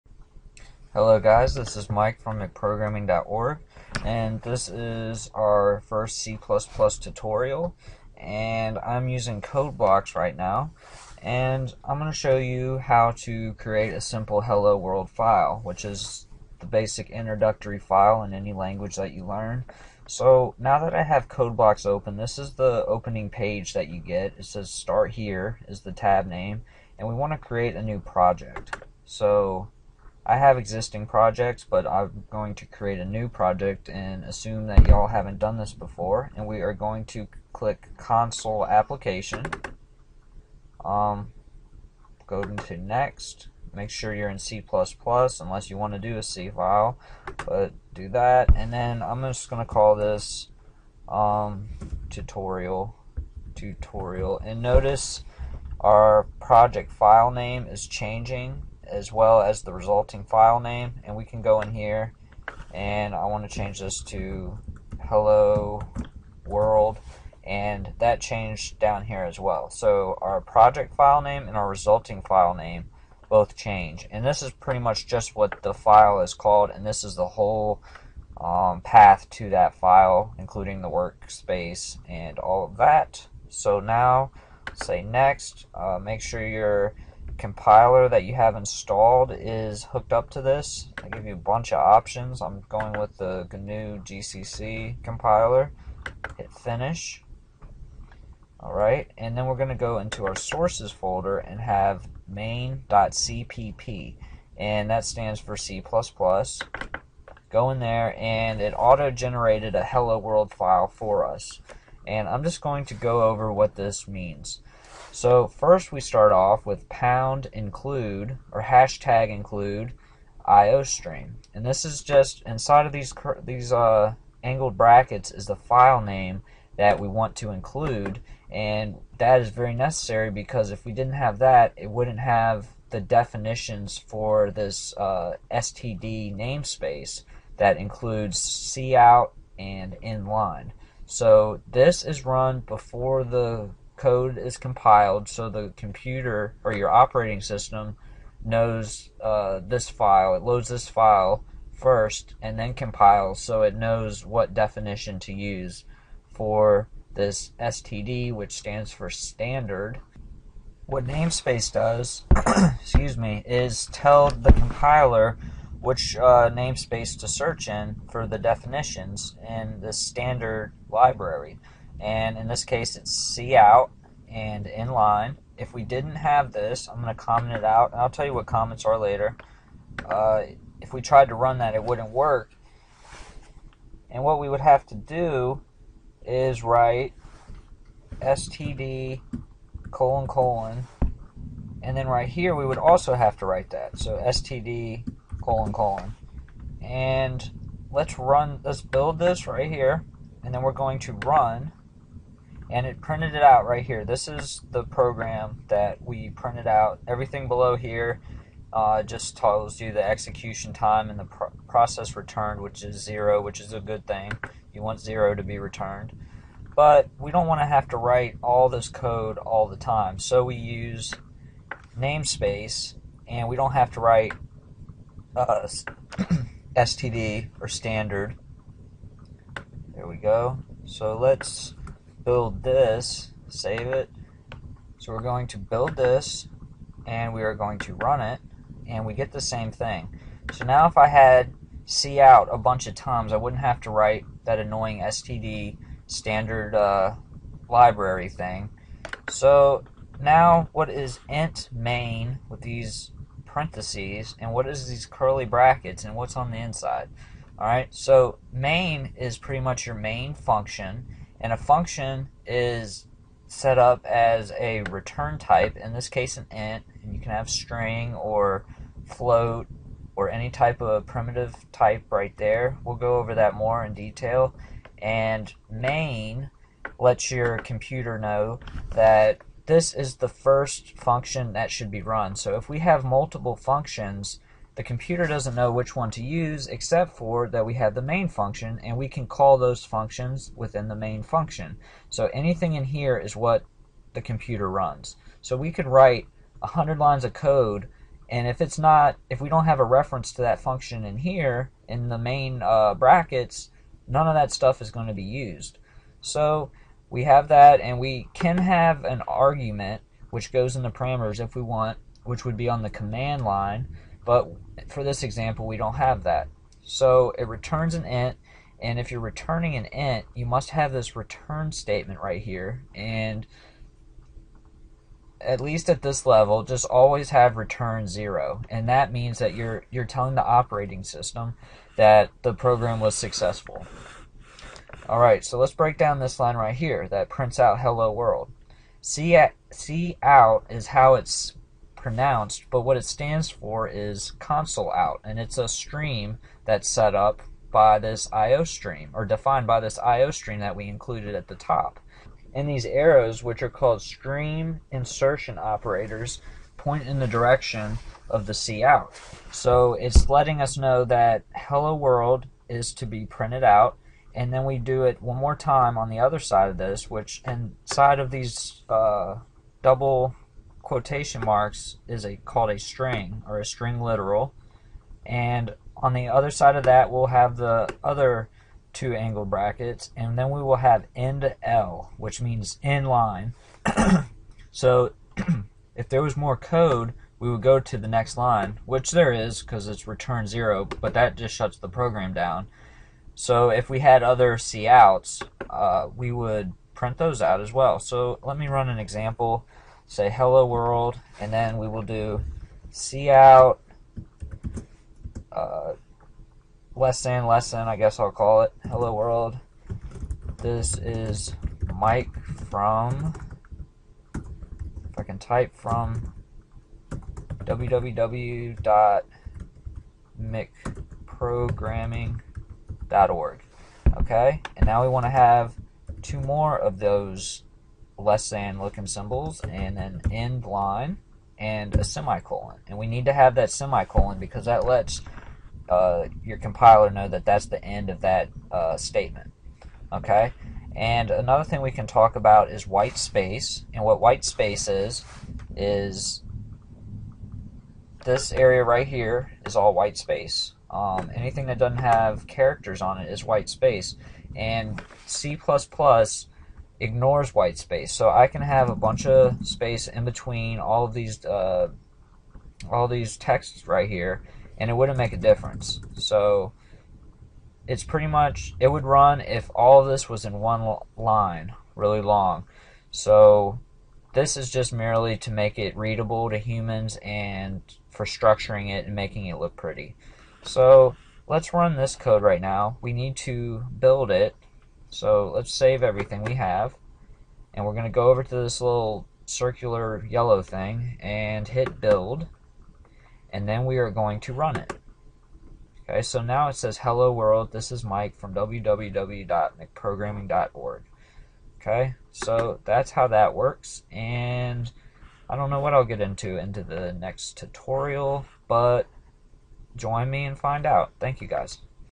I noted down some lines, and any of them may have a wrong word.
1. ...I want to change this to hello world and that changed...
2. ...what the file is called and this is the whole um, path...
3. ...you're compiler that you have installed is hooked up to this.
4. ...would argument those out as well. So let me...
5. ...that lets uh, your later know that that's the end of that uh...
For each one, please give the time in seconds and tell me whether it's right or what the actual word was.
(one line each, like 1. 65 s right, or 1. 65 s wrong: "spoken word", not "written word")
1. 63 s right
2. 75 s right
3. 86 s right
4. 396 s wrong: "print", not "argument"
5. 434 s wrong: "compiler", not "later".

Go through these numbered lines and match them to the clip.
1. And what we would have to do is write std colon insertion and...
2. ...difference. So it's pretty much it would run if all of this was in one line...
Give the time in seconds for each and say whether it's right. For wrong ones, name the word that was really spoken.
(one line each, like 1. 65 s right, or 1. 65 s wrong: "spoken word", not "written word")
1. 184 s wrong: "colon", not "insertion"
2. 465 s right.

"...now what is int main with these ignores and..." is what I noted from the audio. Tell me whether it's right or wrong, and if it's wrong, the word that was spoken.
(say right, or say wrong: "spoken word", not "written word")
wrong: "parentheses", not "ignores".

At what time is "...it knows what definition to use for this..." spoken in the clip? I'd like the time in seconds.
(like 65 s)
153 s.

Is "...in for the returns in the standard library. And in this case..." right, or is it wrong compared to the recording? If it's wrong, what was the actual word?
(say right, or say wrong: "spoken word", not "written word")
wrong: "definitions", not "returns".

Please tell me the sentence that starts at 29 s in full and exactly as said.
So I have existing projects, but I'm going to create a new project and assume that y'all haven't done this before.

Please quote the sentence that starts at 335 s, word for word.
Alright, so let's break down this line right here that prints out hello world.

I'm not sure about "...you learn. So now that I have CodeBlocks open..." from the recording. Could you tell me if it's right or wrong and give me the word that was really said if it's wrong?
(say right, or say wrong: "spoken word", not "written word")
right.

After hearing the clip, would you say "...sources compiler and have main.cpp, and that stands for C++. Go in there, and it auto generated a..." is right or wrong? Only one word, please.
wrong.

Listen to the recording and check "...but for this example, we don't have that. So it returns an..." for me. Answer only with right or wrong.
right.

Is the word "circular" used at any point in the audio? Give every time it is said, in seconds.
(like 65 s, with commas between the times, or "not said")
489 s.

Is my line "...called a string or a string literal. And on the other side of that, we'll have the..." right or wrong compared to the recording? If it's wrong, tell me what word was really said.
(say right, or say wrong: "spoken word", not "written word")
right.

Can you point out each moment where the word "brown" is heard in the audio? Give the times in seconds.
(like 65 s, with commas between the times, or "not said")
not said.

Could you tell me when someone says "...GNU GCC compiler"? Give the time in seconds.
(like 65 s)
93 s.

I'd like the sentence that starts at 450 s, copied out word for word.
Um, anything that doesn't have characters on it is white space, and C++ ignores white space.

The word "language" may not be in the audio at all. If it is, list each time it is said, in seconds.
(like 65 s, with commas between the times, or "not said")
18 s.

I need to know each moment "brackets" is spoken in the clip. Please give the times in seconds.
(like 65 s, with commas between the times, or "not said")
124 s, 255 s, 302 s, 379 s.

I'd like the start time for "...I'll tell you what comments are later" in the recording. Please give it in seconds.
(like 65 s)
178 s.